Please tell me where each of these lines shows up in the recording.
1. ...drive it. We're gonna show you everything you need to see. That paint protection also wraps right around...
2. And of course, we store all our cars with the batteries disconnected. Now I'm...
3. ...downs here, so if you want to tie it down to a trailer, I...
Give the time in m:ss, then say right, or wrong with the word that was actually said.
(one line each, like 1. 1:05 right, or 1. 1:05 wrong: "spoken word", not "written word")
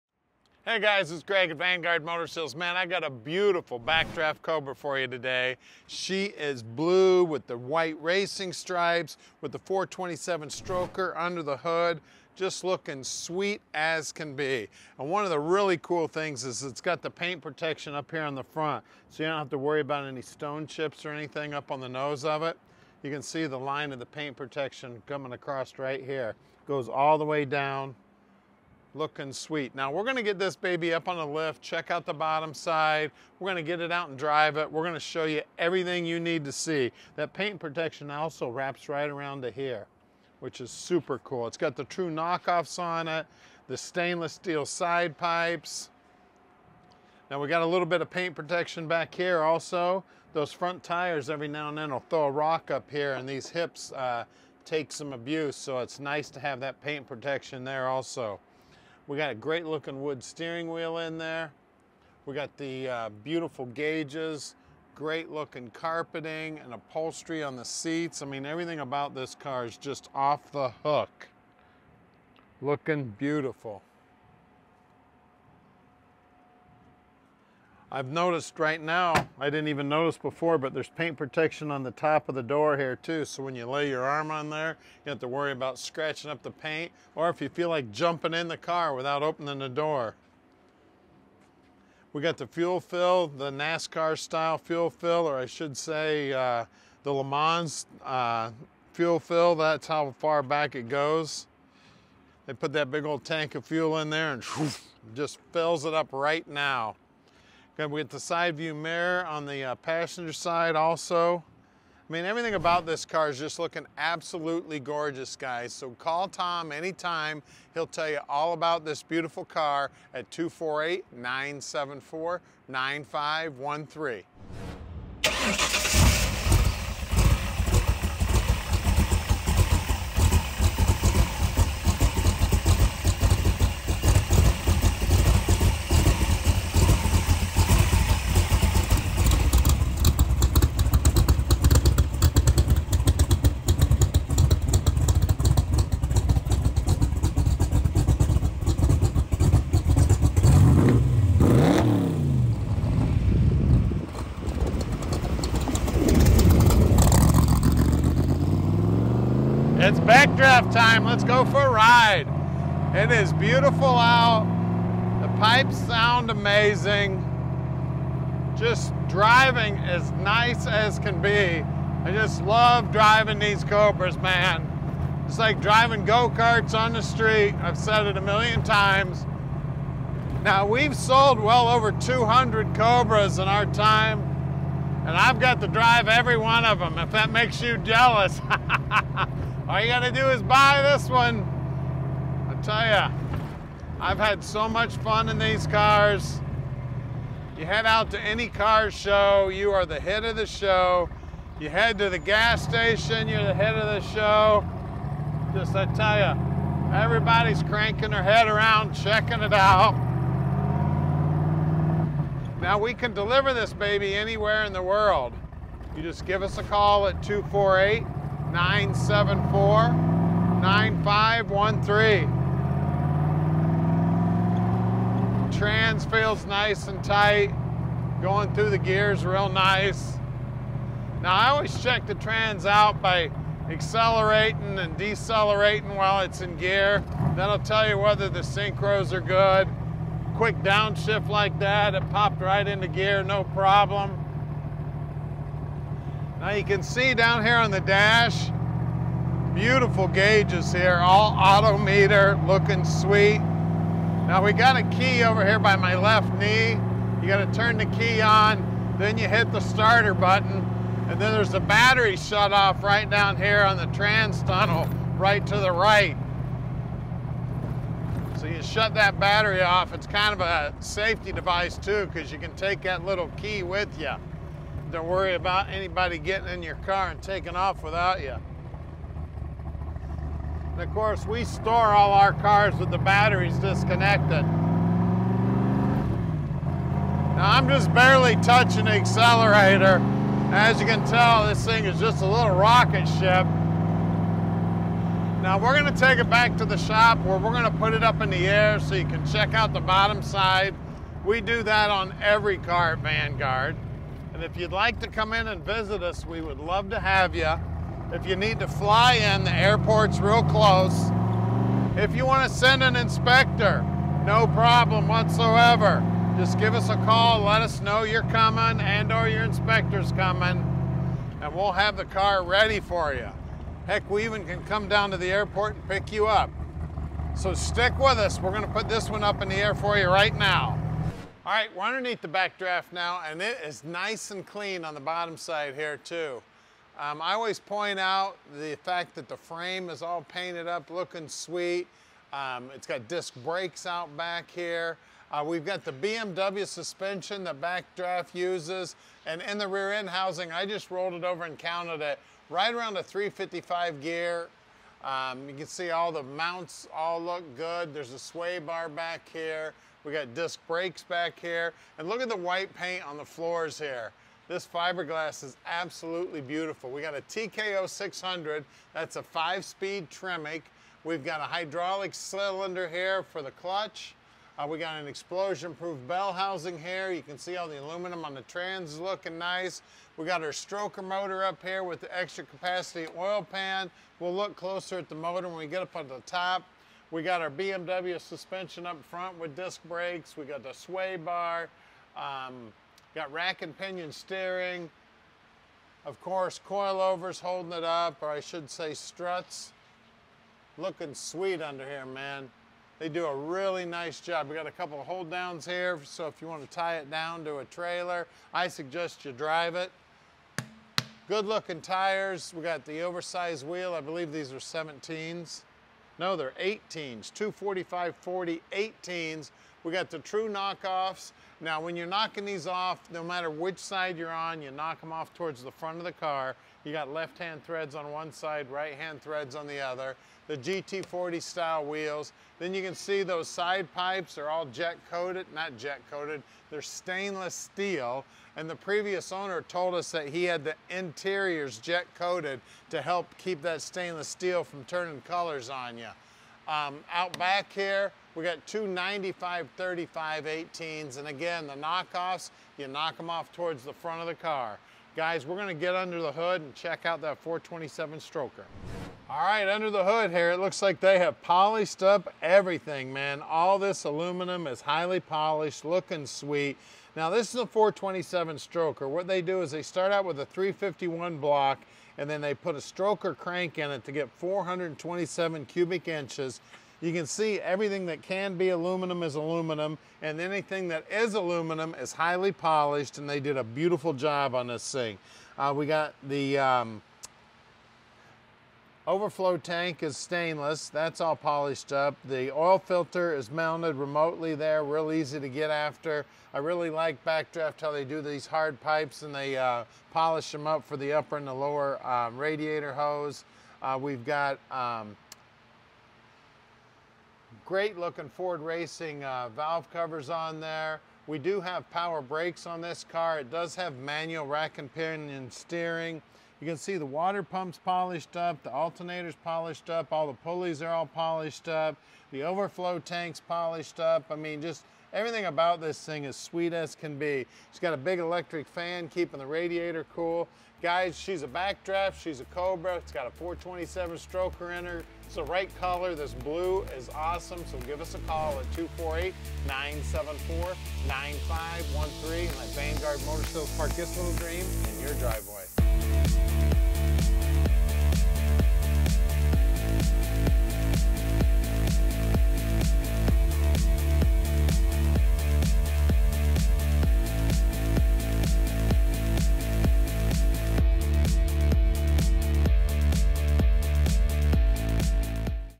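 1. 0:34 right
2. 4:40 right
3. 6:45 right.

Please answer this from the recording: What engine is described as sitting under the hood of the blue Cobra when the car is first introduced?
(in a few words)
427 stroker.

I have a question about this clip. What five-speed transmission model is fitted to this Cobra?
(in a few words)
TKO 600.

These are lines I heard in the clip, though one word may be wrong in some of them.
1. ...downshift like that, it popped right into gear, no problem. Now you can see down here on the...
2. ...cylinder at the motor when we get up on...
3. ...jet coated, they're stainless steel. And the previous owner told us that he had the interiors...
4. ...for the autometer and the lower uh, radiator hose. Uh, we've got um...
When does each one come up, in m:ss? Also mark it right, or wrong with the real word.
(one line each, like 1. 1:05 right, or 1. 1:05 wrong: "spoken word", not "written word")
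1. 4:00 right
2. 6:24 wrong: "closer", not "cylinder"
3. 7:15 right
4. 8:20 wrong: "upper", not "autometer".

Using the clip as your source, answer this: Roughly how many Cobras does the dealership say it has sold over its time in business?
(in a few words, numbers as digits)
over 200.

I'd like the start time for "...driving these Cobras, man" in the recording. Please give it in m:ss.
2:52.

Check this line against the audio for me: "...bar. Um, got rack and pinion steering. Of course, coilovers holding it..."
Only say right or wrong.
right.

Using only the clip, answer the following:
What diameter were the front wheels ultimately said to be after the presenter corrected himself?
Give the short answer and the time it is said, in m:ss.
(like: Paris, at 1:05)
18 inches, at 6:56.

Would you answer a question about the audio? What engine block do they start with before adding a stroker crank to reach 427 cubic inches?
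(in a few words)
351 block.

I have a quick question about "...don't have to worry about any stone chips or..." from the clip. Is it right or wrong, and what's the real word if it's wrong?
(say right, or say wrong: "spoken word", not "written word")
right.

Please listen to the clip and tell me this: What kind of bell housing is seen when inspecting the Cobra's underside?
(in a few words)
Explosion-proof.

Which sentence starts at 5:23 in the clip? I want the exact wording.
Heck, we even can come down to the airport and pick you up.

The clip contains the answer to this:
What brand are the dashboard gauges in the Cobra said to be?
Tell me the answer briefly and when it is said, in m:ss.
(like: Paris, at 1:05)
Autometer, at 4:11.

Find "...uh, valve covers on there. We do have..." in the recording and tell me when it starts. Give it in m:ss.
8:29.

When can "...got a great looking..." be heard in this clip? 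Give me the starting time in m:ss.
0:59.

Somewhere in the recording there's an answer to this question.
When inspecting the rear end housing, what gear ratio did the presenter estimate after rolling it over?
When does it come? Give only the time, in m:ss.
5:53.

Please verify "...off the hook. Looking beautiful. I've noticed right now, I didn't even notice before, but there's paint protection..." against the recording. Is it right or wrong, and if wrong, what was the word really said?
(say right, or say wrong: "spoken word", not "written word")
right.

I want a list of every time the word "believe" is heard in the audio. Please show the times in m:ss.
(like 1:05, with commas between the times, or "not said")
6:54.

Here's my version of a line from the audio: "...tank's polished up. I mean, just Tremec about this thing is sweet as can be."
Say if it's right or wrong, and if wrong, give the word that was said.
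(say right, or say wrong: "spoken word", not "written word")
wrong: "Everything", not "Tremec".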